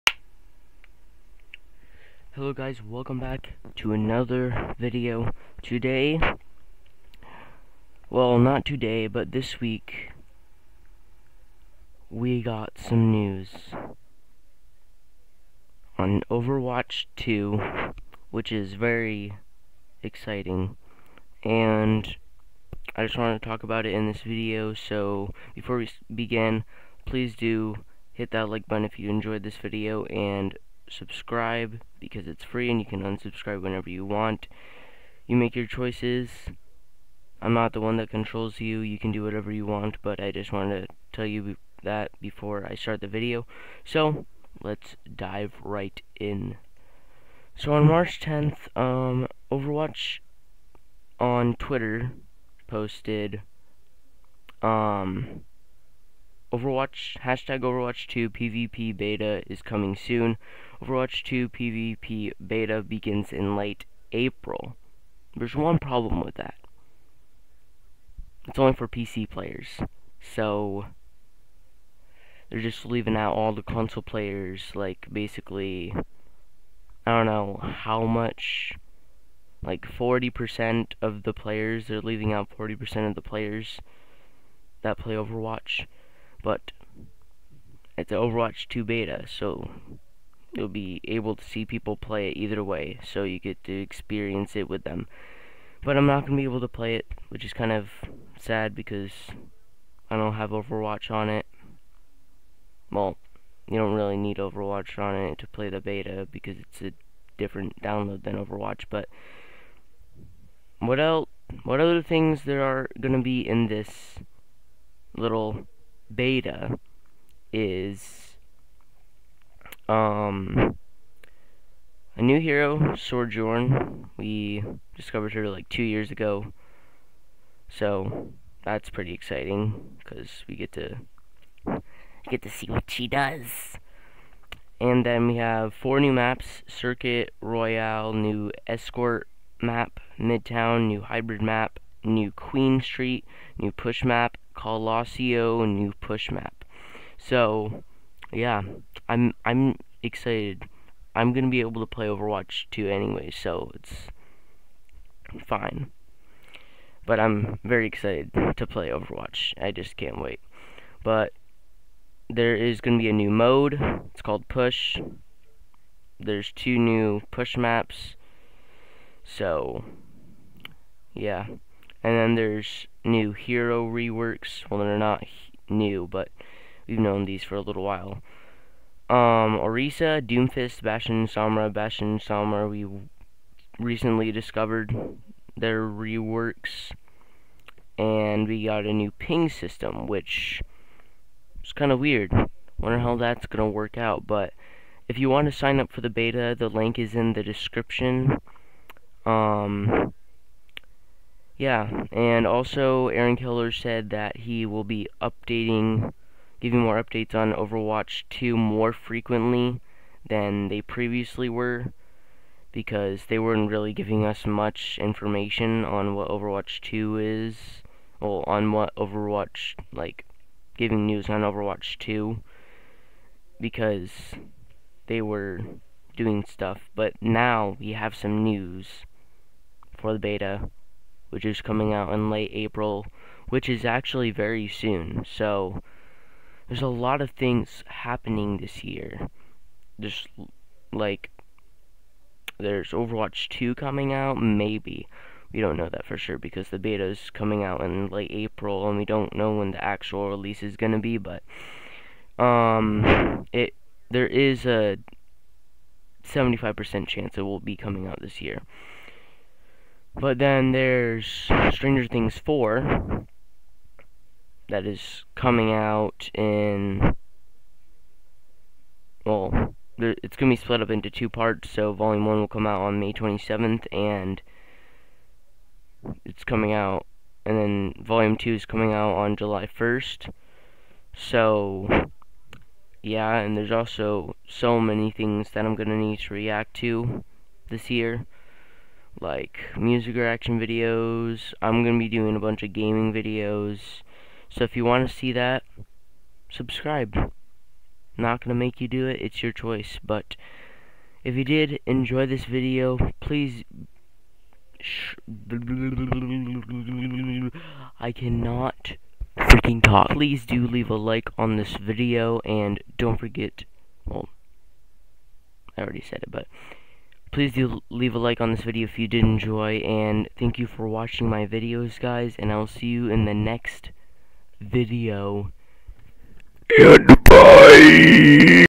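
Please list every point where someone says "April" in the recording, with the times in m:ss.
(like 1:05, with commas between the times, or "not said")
1:04, 3:52, 4:08.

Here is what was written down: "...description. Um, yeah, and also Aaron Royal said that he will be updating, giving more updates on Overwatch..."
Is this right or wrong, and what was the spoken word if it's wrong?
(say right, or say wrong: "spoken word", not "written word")
wrong: "Keller", not "Royal".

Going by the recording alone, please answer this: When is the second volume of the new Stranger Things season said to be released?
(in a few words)
July 1st.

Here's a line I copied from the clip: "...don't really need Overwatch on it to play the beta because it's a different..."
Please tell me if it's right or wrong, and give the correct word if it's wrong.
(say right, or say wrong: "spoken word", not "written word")
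right.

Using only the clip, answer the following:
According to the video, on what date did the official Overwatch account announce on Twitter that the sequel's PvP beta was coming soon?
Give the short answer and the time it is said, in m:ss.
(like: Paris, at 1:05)
March 10th, at 0:47.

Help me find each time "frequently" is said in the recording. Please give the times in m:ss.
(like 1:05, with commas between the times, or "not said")
3:28.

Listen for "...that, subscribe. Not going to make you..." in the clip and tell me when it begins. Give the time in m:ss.
4:55.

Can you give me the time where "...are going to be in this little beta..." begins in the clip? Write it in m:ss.
1:52.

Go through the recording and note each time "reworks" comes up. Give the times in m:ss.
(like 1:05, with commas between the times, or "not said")
2:53, 3:05.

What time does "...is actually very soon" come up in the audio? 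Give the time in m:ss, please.
3:53.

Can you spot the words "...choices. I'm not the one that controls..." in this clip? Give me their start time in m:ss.
0:35.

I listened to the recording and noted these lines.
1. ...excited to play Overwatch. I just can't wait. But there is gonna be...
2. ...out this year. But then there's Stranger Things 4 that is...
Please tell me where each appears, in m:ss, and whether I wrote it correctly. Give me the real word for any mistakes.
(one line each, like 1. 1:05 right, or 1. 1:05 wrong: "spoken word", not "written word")
1. 2:37 right
2. 4:18 right.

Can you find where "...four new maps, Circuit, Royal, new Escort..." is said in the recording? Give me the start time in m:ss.
2:15.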